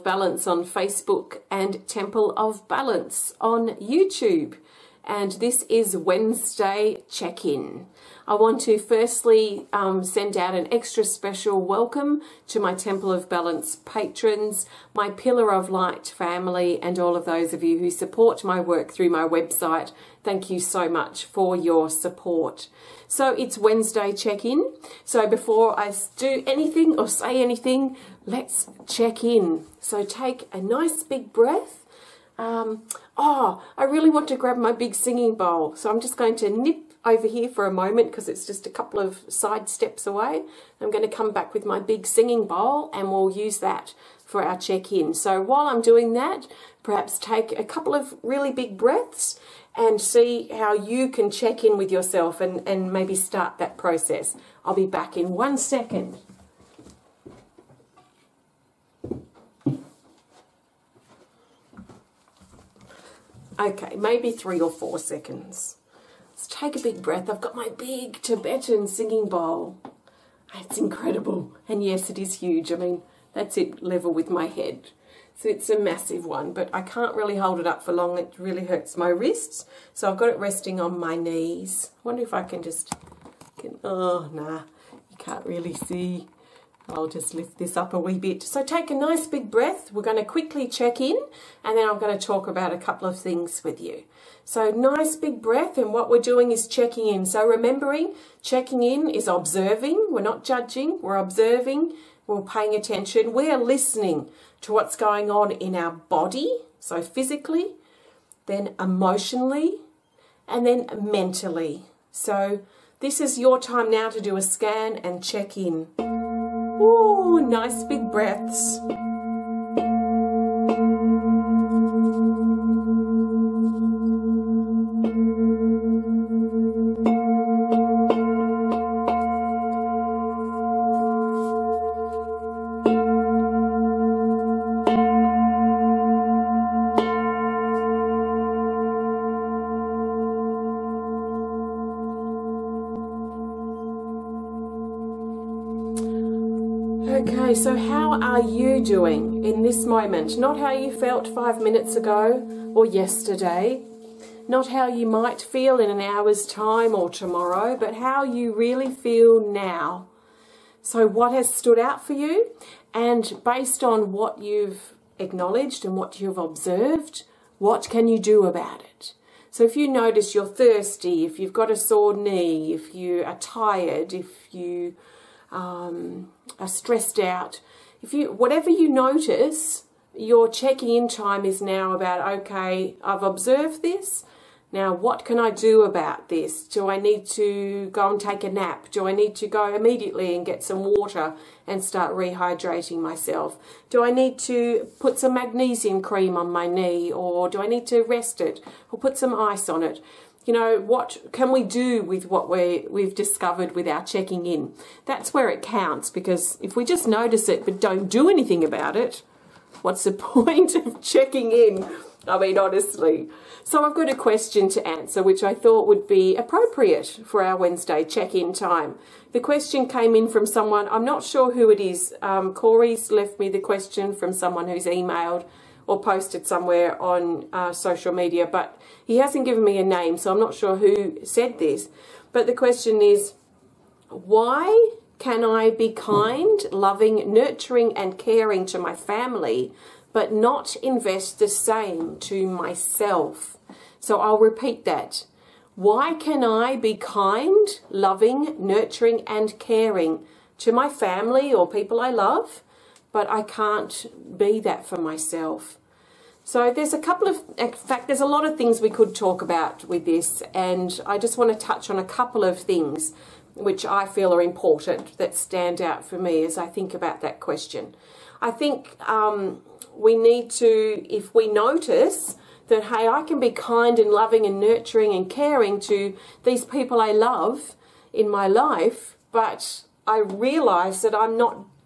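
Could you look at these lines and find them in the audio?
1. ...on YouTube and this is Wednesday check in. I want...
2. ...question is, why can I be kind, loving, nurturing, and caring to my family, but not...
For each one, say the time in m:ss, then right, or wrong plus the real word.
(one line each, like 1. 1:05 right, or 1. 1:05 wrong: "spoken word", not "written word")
1. 0:03 right
2. 3:52 right.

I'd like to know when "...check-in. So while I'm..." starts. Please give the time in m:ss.
0:44.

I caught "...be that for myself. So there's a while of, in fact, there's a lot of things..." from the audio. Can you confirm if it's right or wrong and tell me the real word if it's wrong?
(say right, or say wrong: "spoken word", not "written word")
wrong: "couple", not "while".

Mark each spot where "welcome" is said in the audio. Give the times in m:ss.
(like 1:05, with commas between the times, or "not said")
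0:11.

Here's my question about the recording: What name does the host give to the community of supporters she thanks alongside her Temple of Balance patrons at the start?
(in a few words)
Pillar of Light.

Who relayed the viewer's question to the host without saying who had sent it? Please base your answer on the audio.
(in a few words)
Corey.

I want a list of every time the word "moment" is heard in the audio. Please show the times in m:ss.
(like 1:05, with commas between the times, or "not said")
0:37, 2:29.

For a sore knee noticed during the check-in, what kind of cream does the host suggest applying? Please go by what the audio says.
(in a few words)
magnesium cream.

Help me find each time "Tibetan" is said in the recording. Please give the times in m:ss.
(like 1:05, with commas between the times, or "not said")
1:08.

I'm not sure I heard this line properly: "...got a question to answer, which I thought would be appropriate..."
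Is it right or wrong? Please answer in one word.
right.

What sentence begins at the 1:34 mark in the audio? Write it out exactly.
So nice big breath and what we're doing is checking in.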